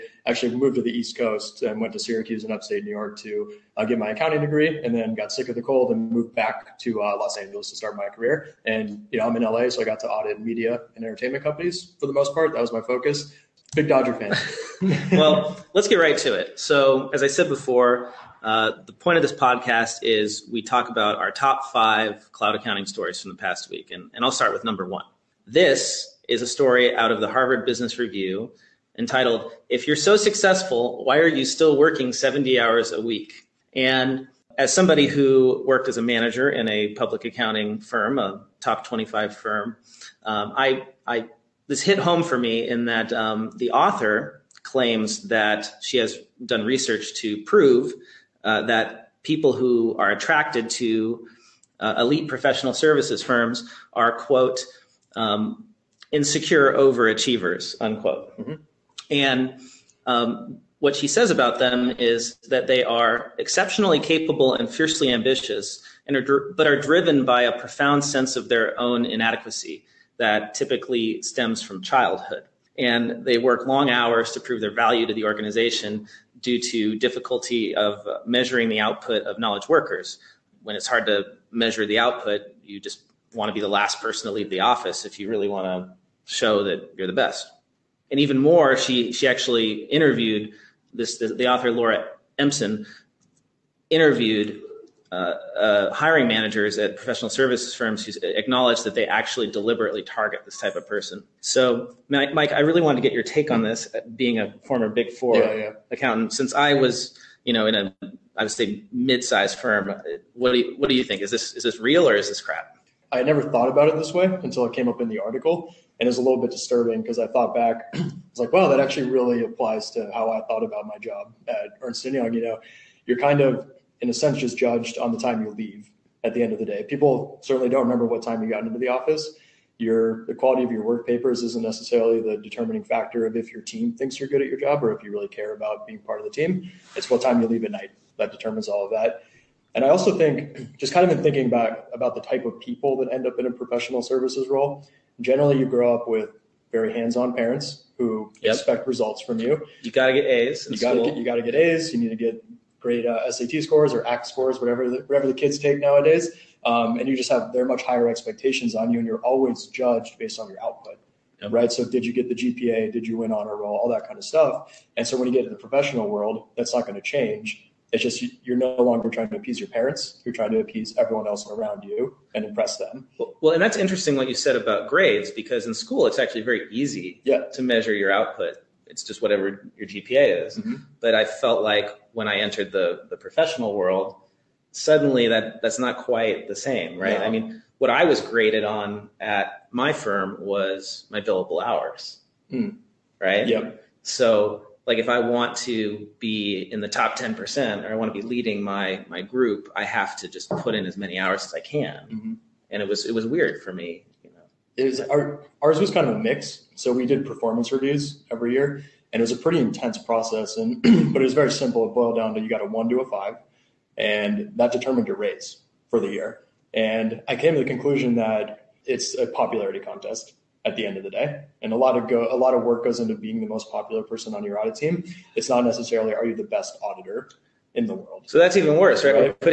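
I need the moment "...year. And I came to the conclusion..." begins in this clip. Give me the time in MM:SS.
03:36.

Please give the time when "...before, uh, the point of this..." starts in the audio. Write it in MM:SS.
00:17.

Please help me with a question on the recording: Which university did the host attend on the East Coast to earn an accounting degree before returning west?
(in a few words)
Syracuse.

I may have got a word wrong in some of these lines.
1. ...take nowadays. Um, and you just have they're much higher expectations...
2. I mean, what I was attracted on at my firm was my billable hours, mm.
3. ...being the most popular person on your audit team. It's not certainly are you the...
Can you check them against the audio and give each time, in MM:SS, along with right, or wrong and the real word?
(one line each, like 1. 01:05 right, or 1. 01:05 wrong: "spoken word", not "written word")
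1. 02:35 right
2. 03:07 wrong: "graded", not "attracted"
3. 03:43 wrong: "necessarily", not "certainly".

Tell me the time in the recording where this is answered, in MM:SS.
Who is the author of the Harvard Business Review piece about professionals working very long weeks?
01:31.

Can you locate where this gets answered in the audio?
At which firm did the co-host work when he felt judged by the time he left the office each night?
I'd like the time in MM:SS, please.
02:01.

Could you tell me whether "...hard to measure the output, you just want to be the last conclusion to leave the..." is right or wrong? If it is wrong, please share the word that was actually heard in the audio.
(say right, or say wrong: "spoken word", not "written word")
wrong: "person", not "conclusion".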